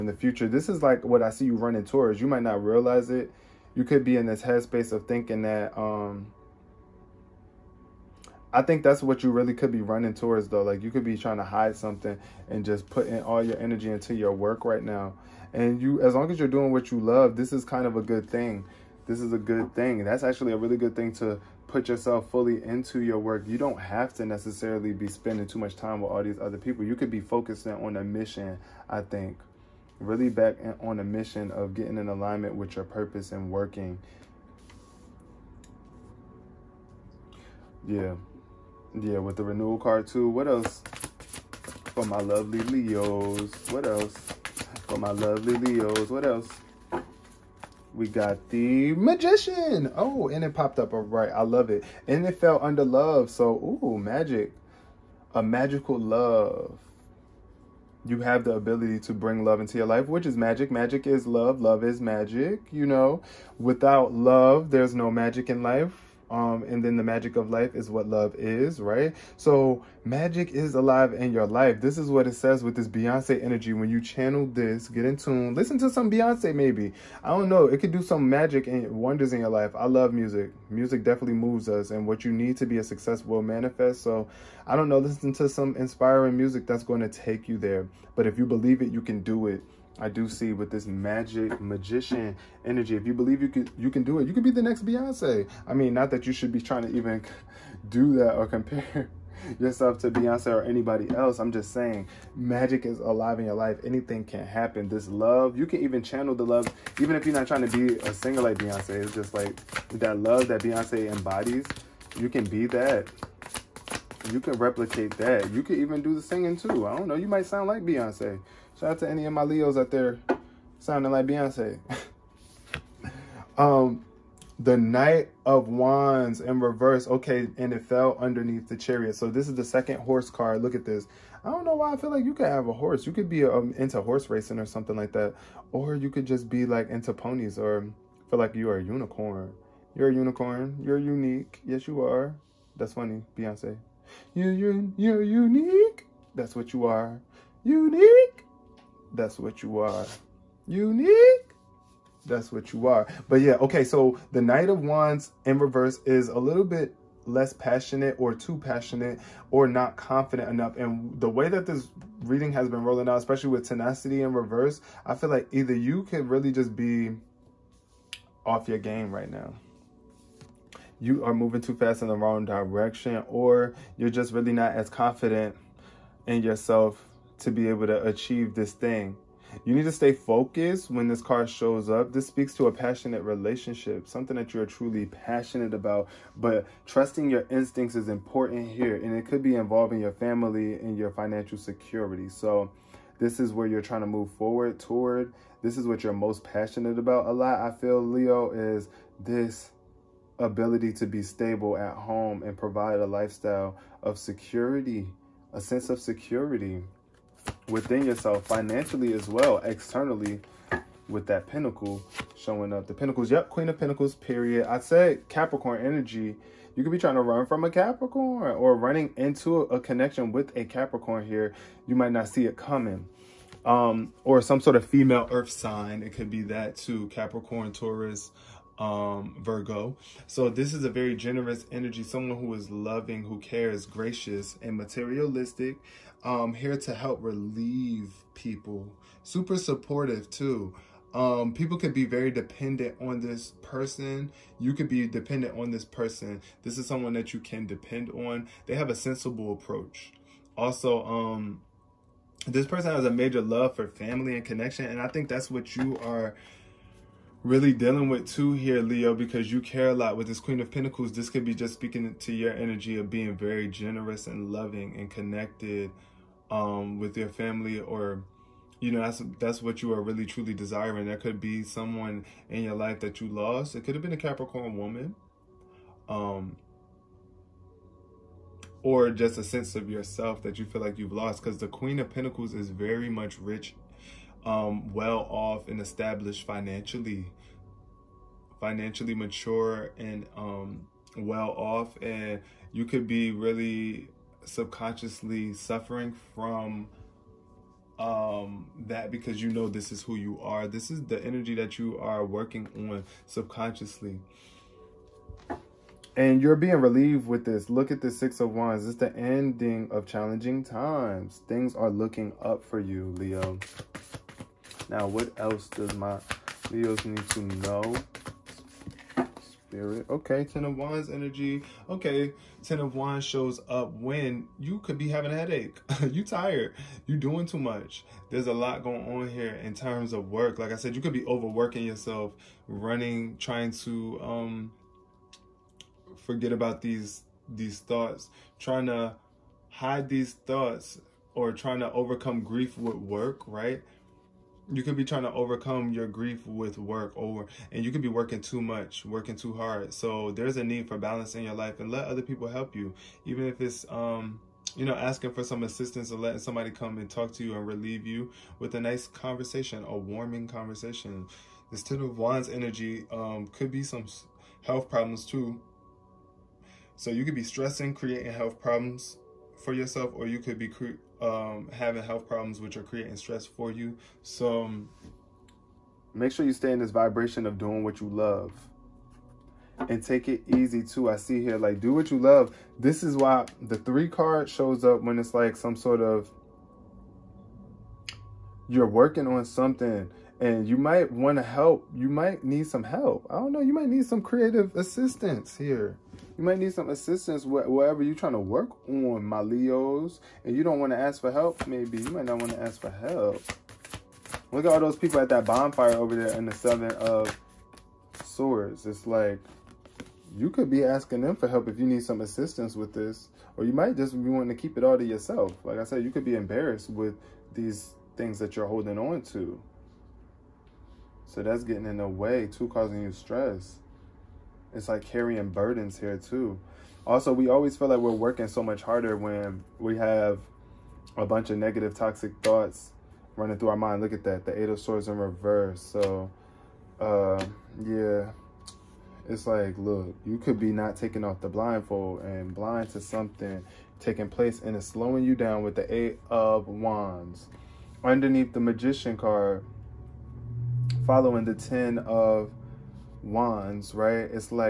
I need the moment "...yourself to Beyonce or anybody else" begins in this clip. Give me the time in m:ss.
1:39.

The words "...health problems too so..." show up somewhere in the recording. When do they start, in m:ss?
6:04.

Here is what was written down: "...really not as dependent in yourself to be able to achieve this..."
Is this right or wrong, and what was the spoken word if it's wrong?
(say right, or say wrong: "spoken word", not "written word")
wrong: "confident", not "dependent".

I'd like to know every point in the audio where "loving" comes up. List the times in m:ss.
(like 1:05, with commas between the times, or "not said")
3:52, 4:24.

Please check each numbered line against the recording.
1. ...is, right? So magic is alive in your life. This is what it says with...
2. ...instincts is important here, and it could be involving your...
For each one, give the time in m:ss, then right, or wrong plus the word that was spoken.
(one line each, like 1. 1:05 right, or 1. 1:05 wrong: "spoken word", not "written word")
1. 1:08 right
2. 3:07 right.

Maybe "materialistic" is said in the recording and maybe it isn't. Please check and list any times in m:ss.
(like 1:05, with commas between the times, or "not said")
3:54.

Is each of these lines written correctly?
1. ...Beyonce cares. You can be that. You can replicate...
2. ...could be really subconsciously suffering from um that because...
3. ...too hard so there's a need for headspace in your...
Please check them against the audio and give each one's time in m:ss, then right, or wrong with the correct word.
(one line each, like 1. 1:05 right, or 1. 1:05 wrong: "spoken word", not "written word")
1. 1:50 wrong: "embodies", not "cares"
2. 4:52 right
3. 5:49 wrong: "balance", not "headspace".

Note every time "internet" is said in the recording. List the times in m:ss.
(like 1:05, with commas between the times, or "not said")
not said.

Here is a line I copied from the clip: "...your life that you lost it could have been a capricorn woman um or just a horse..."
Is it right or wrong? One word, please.
wrong.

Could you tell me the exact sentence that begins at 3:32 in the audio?
The pentacles, yep, queen of pentacles, period.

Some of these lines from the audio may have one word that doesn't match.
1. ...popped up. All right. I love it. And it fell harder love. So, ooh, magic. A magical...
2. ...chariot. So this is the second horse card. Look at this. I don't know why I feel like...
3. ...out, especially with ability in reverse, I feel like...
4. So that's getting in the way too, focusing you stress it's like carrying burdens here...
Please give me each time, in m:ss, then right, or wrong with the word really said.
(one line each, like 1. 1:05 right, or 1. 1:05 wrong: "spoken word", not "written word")
1. 0:50 wrong: "under", not "harder"
2. 2:08 right
3. 2:43 wrong: "tenacity", not "ability"
4. 7:01 wrong: "causing", not "focusing".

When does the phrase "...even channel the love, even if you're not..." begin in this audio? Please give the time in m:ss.
1:45.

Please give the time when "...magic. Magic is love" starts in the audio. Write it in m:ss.
1:00.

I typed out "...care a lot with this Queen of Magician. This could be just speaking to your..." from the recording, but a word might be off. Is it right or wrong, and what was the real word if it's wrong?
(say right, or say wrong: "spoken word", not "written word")
wrong: "Pentacles", not "Magician".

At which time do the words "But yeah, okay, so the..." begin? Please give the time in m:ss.
2:33.